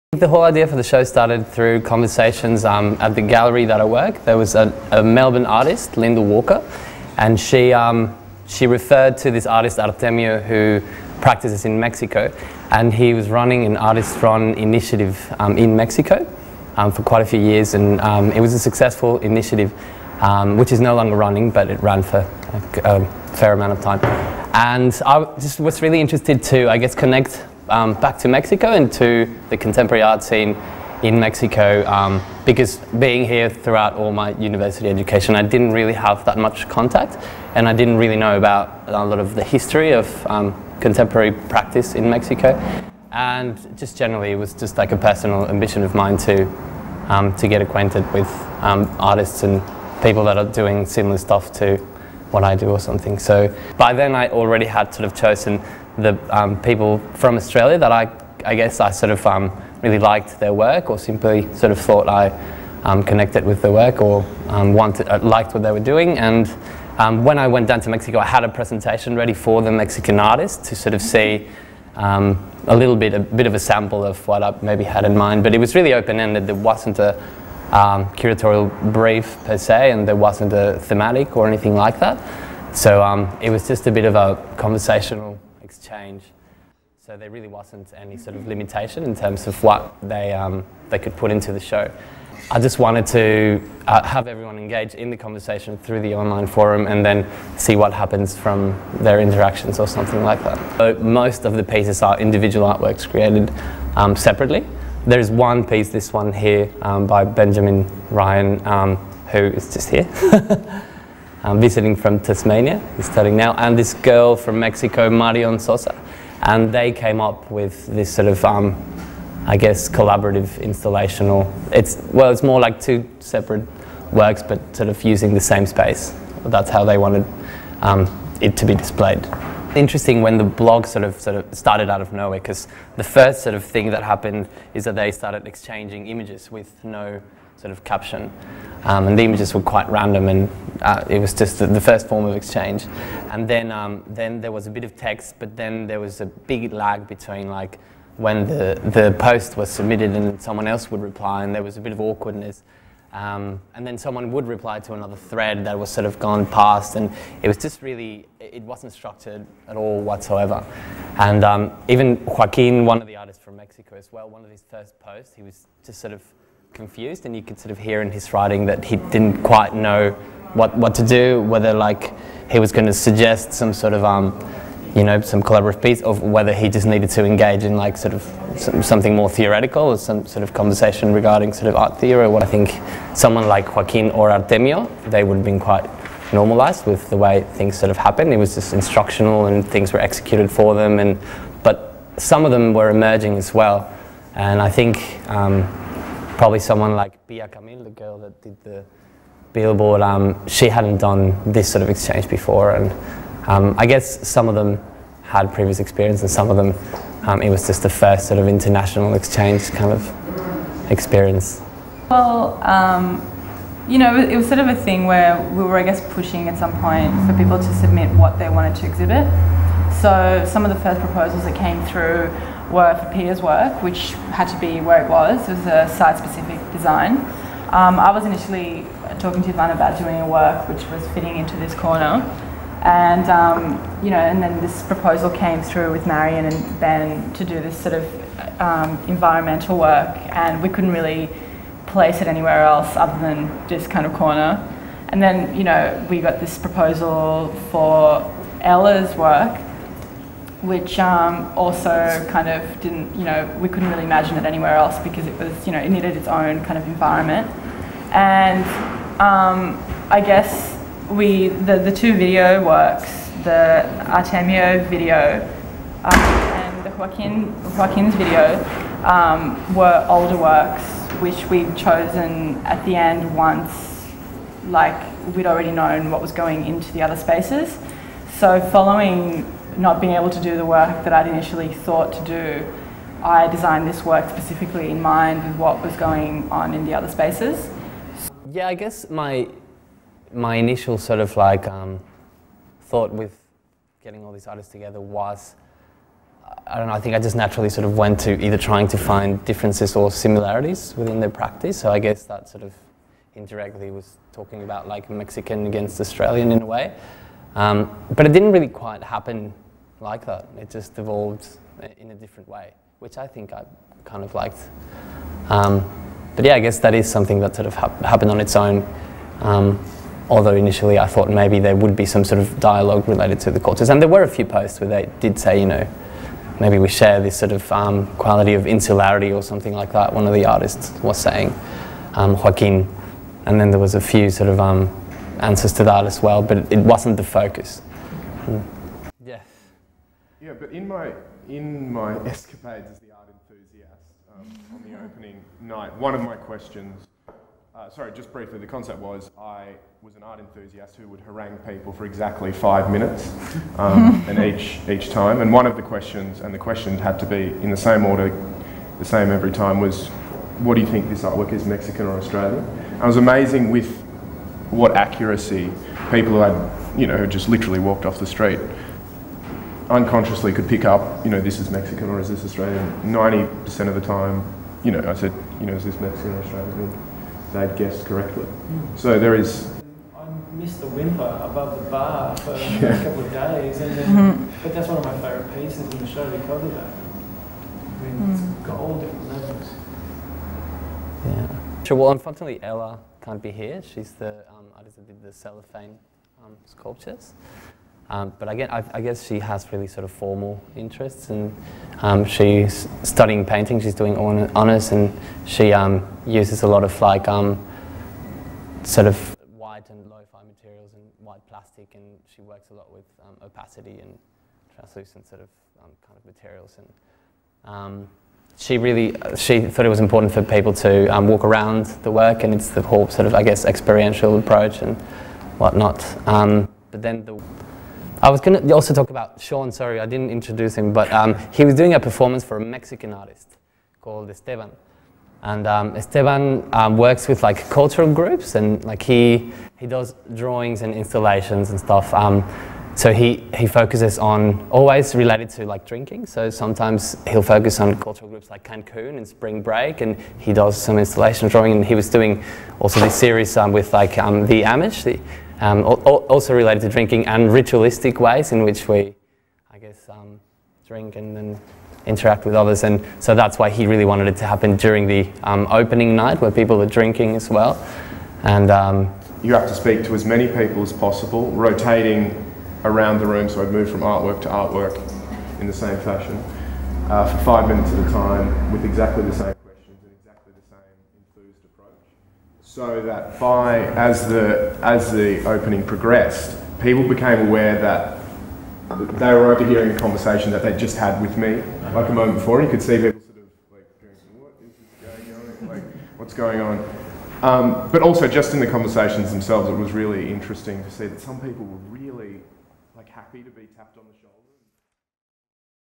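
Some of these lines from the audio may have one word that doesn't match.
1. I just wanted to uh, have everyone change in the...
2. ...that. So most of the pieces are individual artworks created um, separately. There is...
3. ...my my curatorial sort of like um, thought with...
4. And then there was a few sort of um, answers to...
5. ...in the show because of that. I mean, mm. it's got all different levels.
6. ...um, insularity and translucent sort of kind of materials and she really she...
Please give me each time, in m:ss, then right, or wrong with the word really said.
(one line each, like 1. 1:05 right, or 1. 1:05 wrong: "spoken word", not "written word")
1. 1:32 wrong: "engage", not "change"
2. 1:40 right
3. 4:49 wrong: "initial", not "curatorial"
4. 5:33 right
5. 6:25 right
6. 6:53 wrong: "opacity", not "insularity".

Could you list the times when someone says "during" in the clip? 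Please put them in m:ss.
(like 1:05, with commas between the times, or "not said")
7:44.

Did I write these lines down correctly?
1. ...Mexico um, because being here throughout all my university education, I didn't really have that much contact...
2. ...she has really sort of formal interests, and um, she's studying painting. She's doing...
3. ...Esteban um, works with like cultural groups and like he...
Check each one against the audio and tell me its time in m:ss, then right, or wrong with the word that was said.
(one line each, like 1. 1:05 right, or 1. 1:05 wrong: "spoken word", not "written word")
1. 0:31 right
2. 6:39 right
3. 7:15 right.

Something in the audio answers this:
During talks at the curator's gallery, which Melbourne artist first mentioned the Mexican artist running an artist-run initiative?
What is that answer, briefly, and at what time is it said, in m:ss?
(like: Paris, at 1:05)
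Linda Walker, at 0:05.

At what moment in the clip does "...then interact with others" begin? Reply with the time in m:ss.
7:41.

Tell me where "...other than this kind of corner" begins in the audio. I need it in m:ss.
4:02.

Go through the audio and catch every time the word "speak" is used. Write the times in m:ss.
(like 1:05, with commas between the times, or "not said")
7:49.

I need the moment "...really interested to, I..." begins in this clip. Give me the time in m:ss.
0:25.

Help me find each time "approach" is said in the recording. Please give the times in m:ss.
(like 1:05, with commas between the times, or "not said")
7:04, 8:01.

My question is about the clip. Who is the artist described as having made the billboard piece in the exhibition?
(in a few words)
Pia Camil.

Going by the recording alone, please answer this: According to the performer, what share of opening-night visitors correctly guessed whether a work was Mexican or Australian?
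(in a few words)
90%.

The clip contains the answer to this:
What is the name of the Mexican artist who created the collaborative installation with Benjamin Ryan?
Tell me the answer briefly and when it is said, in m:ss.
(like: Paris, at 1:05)
Marion Sosa, at 1:55.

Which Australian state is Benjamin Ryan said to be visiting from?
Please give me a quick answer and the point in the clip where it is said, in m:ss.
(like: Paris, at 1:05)
Tasmania, at 1:52.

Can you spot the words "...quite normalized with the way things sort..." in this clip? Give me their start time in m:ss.
3:05.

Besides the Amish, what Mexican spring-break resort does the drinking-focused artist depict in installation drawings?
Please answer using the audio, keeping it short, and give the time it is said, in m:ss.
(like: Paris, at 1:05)
Cancun, at 7:28.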